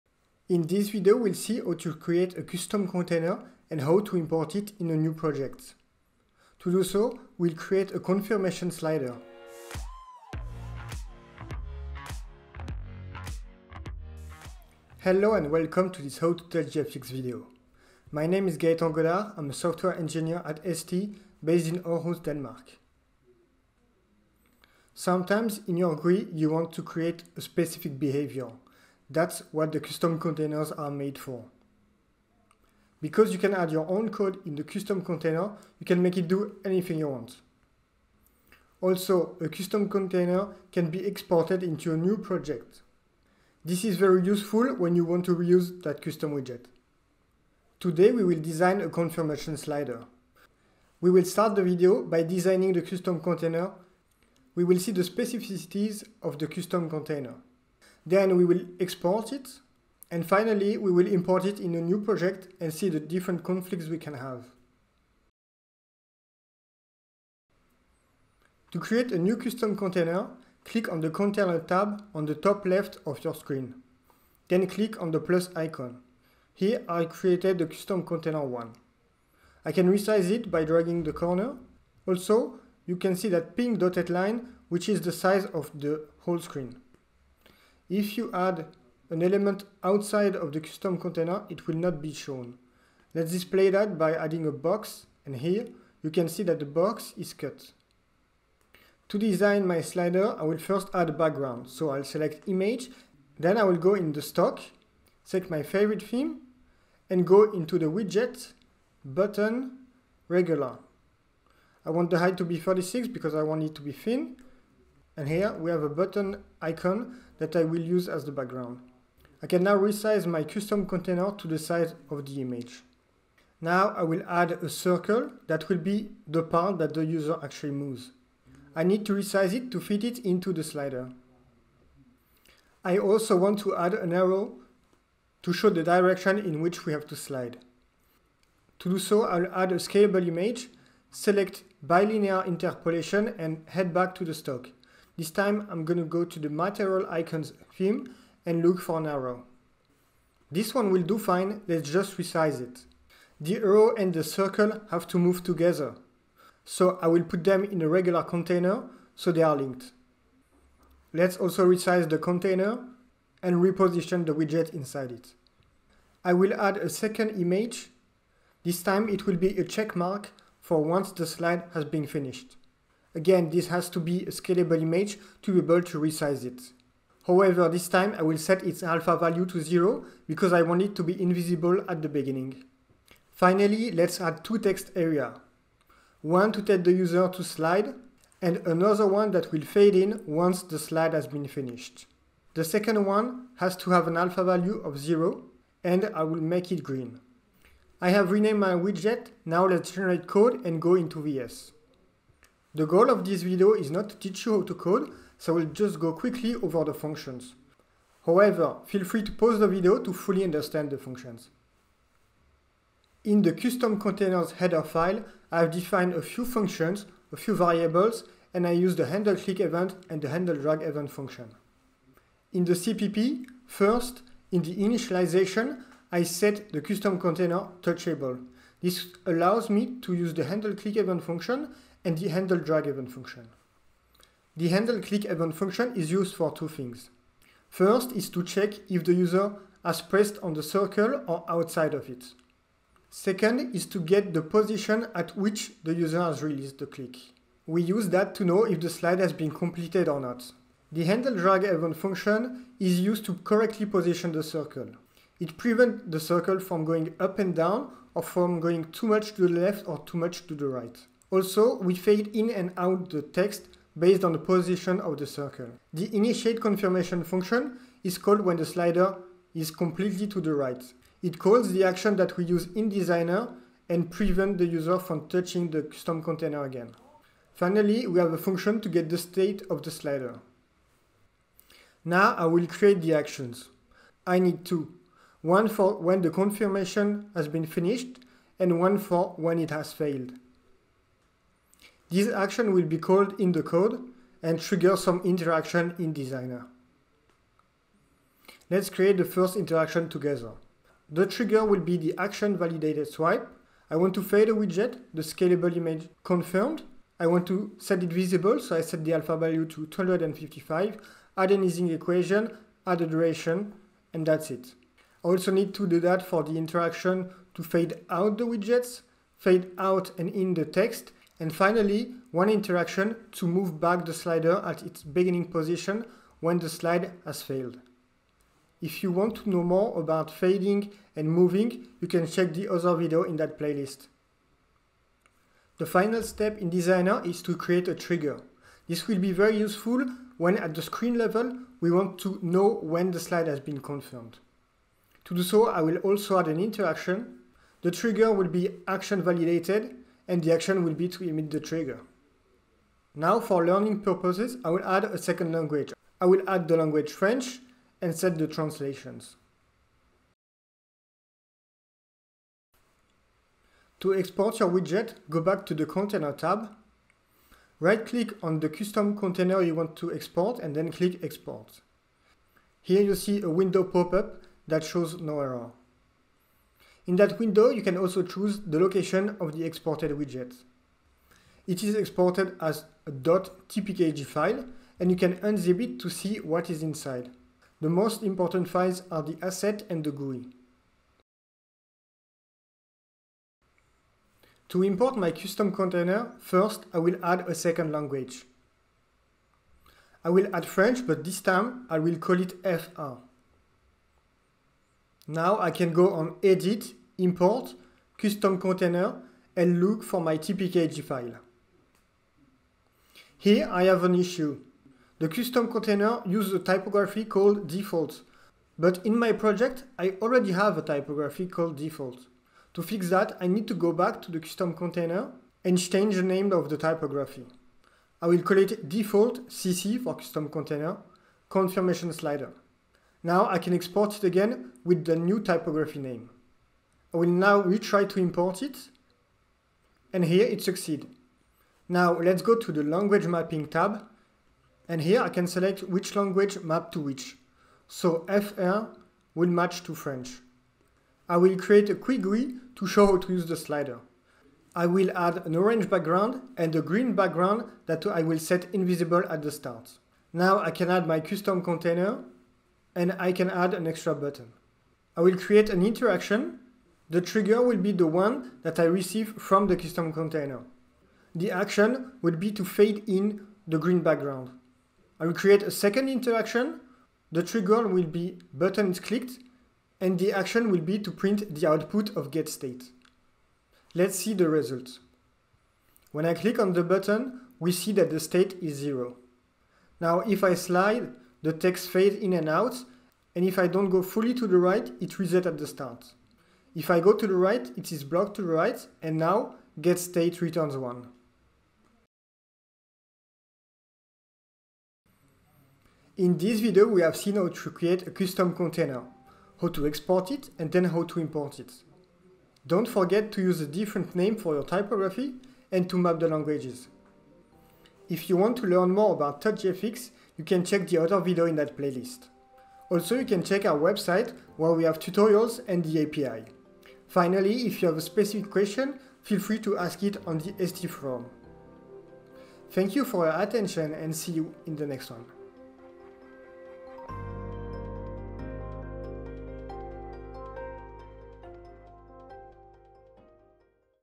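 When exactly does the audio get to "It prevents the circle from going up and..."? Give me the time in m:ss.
4:15.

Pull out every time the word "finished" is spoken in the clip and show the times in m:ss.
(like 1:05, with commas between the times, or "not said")
2:52, 3:11, 4:47.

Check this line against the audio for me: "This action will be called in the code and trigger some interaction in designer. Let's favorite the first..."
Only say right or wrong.
wrong.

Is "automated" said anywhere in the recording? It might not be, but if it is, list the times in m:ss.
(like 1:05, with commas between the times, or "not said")
not said.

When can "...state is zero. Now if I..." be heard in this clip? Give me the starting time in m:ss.
8:08.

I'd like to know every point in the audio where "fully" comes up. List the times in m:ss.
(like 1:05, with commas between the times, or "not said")
3:30, 8:14.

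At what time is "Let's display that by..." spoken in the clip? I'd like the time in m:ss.
1:33.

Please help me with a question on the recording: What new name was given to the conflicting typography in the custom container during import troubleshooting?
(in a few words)
default cc.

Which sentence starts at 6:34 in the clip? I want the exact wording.
To import my custom container, first I will add a second language.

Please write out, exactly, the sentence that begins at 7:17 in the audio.
I will now retry to import it.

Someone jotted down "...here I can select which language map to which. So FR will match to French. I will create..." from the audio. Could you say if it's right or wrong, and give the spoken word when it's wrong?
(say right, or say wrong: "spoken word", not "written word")
right.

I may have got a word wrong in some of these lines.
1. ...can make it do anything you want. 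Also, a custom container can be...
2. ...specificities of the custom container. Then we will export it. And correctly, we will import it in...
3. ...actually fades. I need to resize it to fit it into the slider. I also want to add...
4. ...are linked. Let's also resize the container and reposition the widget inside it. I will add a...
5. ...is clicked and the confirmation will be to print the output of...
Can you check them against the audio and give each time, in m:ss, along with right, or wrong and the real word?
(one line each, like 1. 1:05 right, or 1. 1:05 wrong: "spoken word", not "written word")
1. 0:35 right
2. 0:55 wrong: "finally", not "correctly"
3. 2:07 wrong: "moves", not "fades"
4. 2:39 right
5. 7:58 wrong: "action", not "confirmation".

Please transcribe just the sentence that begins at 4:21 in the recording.
Also, we fade in and out the text based on the position of the circle.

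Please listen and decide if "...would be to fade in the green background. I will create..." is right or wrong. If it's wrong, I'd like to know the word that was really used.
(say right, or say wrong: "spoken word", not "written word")
right.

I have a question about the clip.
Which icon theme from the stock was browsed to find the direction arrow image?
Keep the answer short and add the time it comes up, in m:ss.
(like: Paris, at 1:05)
material icons, at 2:26.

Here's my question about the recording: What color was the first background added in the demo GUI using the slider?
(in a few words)
orange.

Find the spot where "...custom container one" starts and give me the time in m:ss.
1:17.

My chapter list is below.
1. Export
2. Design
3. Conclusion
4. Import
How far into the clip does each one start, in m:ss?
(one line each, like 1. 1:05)
1. 6:01
2. 1:07
3. 8:23
4. 6:32.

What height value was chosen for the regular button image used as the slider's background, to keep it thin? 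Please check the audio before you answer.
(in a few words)
36.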